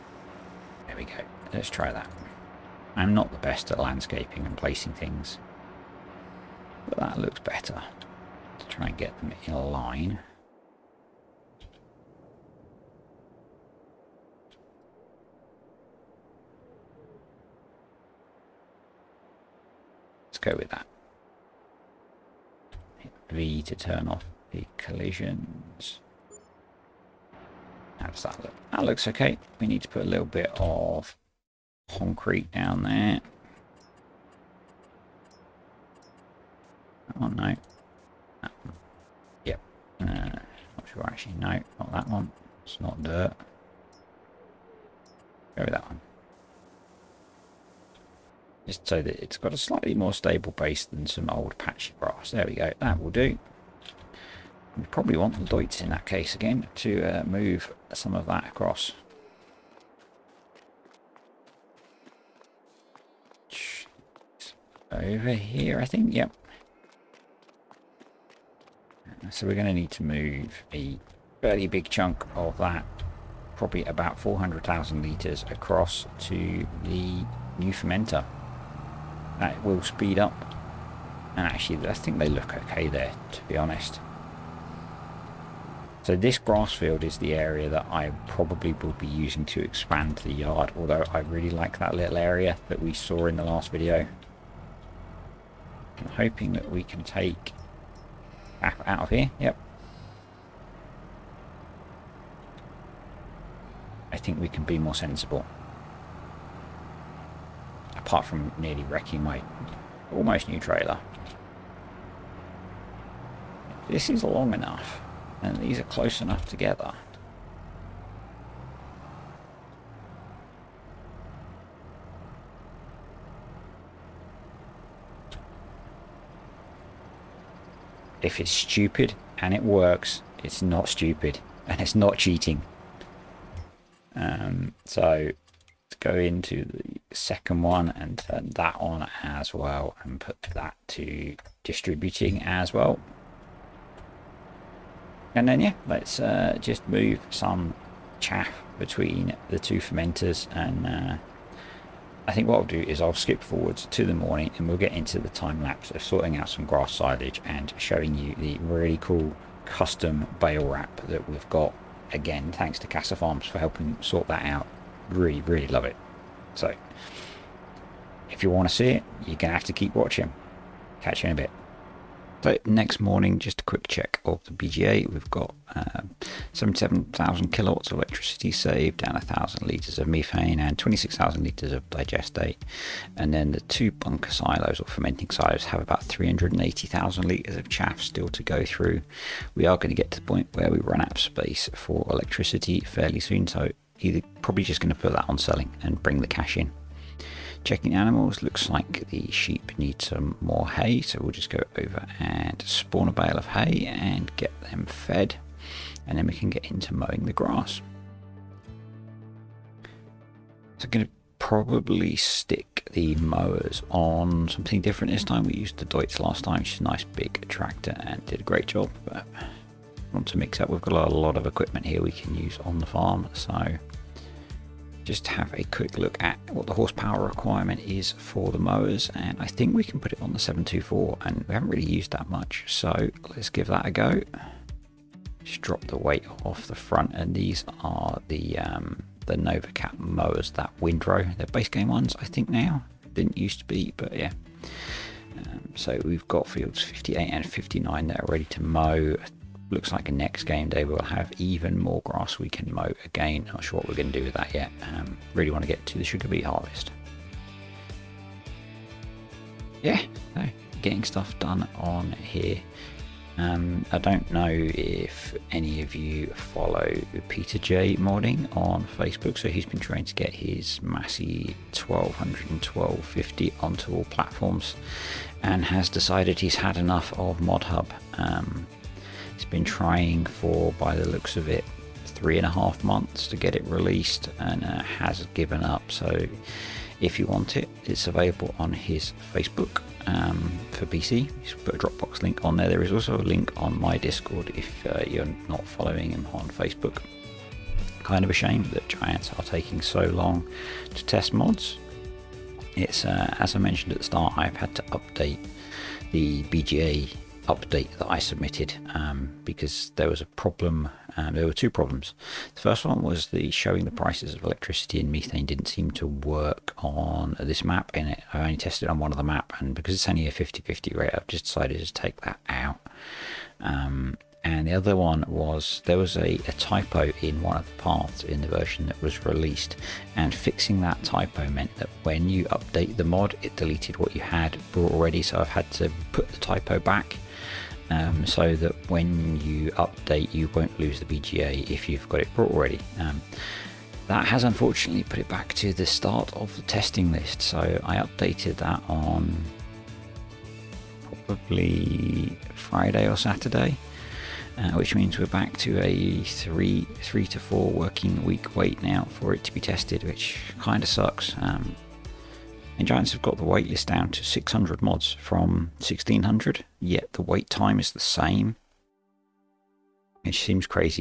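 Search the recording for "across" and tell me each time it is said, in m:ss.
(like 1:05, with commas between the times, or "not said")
0:58, 1:15.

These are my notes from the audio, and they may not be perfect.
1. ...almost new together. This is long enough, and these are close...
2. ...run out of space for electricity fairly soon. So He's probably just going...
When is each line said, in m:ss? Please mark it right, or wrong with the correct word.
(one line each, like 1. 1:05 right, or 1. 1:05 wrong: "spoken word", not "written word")
1. 1:50 wrong: "trailer", not "together"
2. 3:10 right.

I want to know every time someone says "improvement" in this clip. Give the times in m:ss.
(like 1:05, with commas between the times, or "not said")
not said.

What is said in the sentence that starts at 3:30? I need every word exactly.
So I'm going to probably stick the mowers on something different this time.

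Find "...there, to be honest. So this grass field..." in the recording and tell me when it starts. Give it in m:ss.
1:22.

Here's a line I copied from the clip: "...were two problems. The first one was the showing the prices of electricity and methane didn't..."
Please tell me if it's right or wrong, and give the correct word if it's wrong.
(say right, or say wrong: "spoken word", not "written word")
right.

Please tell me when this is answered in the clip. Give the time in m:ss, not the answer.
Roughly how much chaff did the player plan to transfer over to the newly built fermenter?
1:14.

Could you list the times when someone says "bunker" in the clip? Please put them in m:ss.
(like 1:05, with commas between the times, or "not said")
3:03.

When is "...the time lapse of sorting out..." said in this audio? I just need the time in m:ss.
2:35.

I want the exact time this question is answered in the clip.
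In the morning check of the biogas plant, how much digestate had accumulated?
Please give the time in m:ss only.
3:00.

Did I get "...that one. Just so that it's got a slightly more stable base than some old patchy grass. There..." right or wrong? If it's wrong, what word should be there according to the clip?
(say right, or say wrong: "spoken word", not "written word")
right.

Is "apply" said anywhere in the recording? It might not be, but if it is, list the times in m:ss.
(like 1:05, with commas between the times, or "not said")
not said.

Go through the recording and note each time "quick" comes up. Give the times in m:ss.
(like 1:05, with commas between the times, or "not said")
2:53, 3:45.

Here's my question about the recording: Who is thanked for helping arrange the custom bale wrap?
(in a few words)
Casa Farms.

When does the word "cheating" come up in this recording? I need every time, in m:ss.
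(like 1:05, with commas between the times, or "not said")
2:12.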